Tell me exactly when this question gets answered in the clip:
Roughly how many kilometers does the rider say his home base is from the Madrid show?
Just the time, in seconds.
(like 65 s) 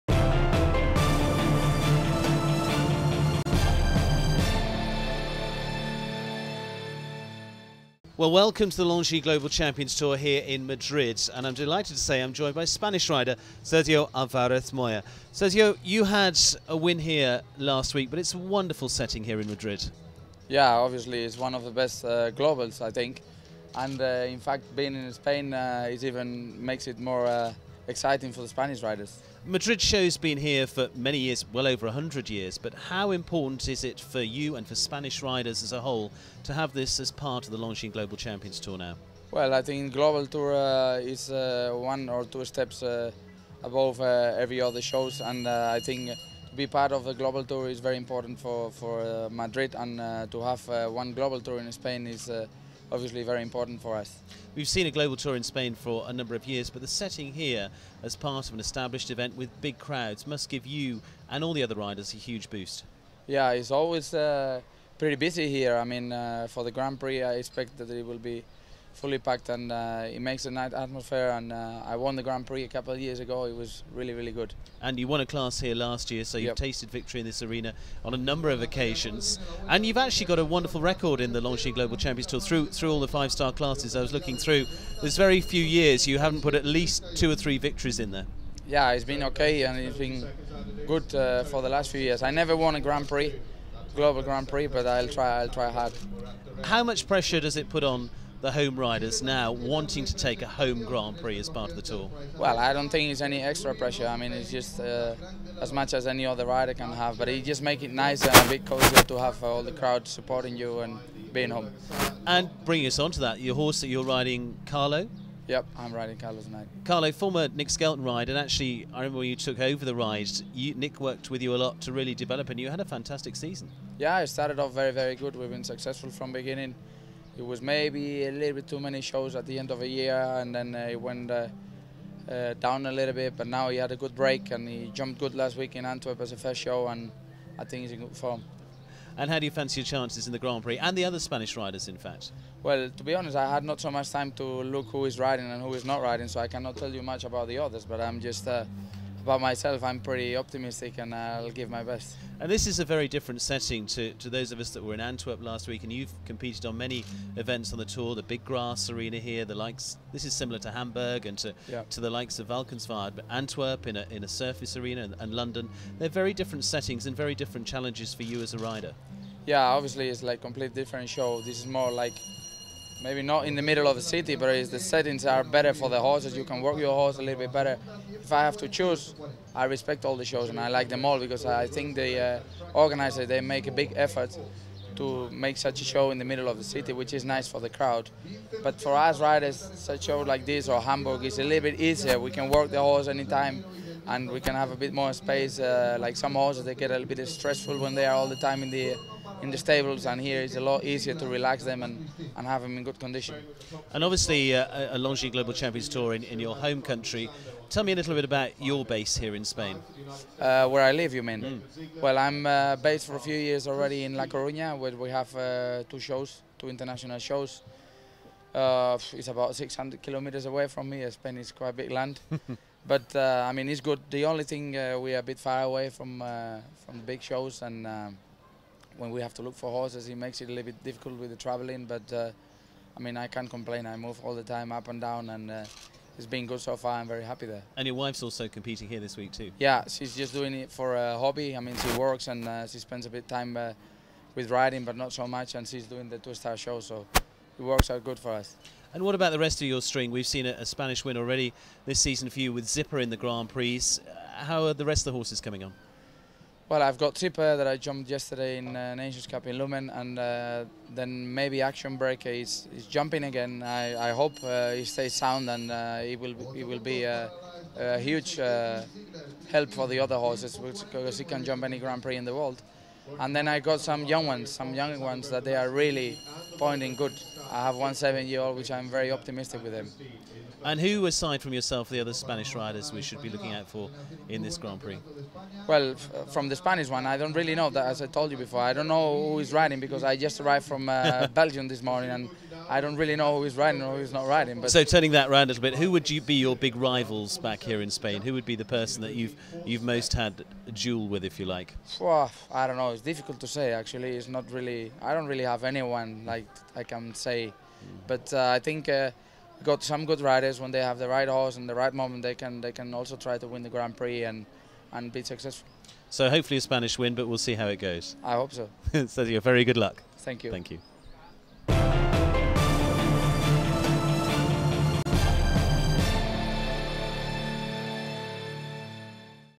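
219 s.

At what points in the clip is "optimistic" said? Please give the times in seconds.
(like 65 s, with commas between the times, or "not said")
150 s, 279 s.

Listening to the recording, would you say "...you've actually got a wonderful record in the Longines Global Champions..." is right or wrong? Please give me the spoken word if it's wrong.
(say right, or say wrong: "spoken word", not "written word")
right.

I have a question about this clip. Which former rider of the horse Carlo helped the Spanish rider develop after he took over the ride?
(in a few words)
Nick Skelton.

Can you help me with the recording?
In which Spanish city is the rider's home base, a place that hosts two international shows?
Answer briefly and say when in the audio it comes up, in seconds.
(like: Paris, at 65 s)
La Coruña, at 214 s.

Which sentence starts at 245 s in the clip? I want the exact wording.
And she's doing the two-star show, so it works out good for us.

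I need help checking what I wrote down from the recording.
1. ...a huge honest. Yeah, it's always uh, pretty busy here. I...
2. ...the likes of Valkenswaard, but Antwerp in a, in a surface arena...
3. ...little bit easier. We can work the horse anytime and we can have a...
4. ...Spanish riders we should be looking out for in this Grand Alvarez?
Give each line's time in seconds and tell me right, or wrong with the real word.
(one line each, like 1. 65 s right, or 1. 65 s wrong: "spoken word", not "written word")
1. 62 s wrong: "boost", not "honest"
2. 162 s right
3. 191 s right
4. 282 s wrong: "Prix", not "Alvarez".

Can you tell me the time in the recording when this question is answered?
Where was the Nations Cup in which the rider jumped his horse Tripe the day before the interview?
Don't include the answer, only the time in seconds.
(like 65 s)
259 s.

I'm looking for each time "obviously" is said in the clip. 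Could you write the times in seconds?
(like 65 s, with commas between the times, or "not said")
20 s, 52 s, 169 s, 204 s.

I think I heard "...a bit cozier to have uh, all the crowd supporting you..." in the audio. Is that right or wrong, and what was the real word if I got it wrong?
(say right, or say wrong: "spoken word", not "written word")
right.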